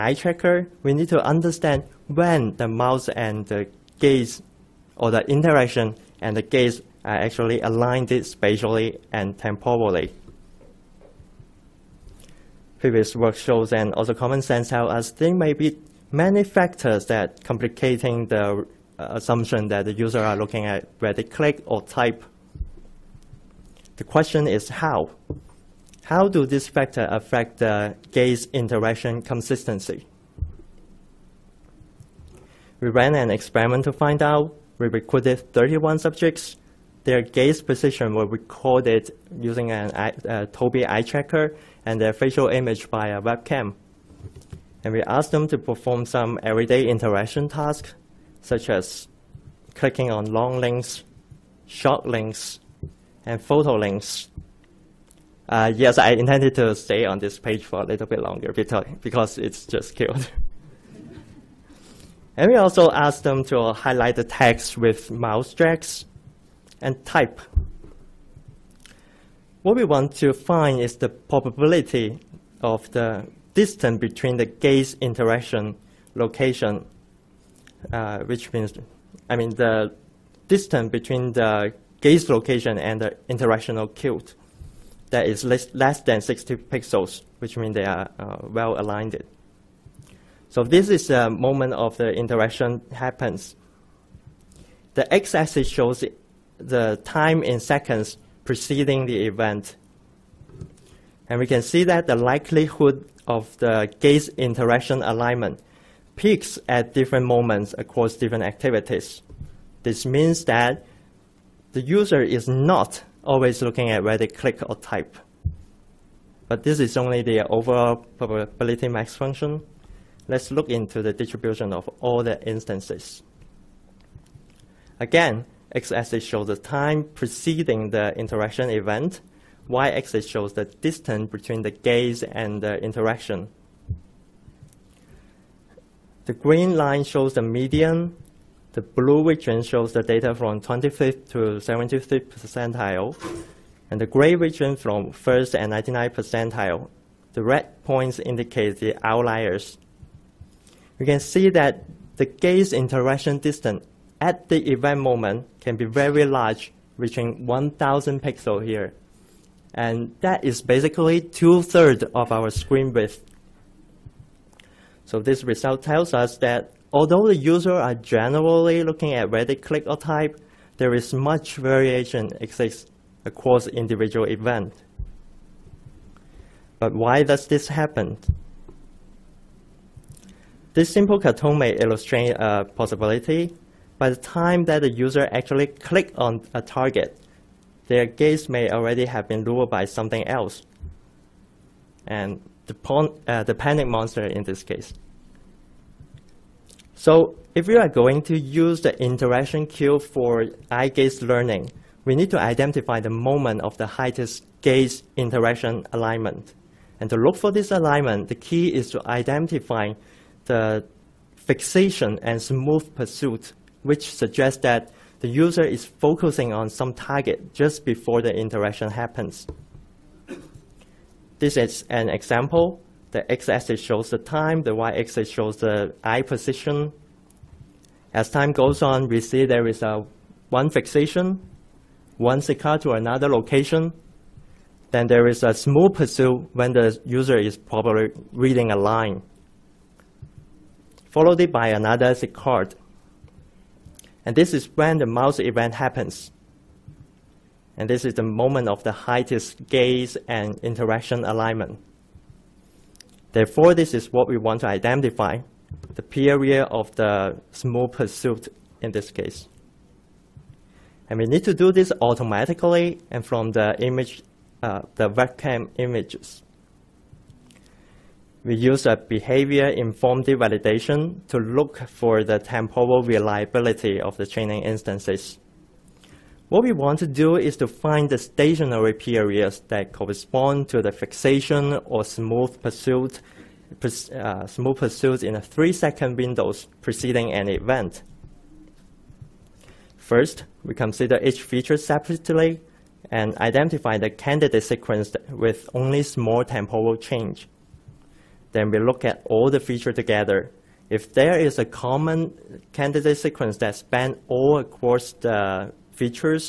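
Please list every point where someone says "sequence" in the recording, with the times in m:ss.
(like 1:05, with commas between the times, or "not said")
4:54, 5:03.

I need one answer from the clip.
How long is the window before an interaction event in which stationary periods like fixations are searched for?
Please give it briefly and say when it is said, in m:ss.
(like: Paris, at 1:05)
3 seconds, at 4:45.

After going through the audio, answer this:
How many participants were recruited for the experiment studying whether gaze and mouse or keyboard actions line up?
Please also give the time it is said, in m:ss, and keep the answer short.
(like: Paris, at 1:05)
31, at 0:35.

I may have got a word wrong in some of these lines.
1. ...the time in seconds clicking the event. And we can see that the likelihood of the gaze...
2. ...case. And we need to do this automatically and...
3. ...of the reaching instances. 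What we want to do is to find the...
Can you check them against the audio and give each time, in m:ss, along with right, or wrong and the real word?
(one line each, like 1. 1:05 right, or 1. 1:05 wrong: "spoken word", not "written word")
1. 1:36 wrong: "preceding", not "clicking"
2. 4:19 right
3. 4:33 wrong: "training", not "reaching".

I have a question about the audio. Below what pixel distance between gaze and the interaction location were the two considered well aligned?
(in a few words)
60 pixels.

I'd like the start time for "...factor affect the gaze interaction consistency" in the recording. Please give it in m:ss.
0:26.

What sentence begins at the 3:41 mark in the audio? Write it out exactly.
This is an example the x-axis shows the time, the y-axis shows the eye position.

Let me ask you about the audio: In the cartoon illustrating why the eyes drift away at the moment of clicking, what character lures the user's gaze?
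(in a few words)
the panic monster.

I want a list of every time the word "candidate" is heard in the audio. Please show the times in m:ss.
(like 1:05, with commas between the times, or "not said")
4:54, 5:02.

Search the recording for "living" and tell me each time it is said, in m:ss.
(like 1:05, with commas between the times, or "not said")
not said.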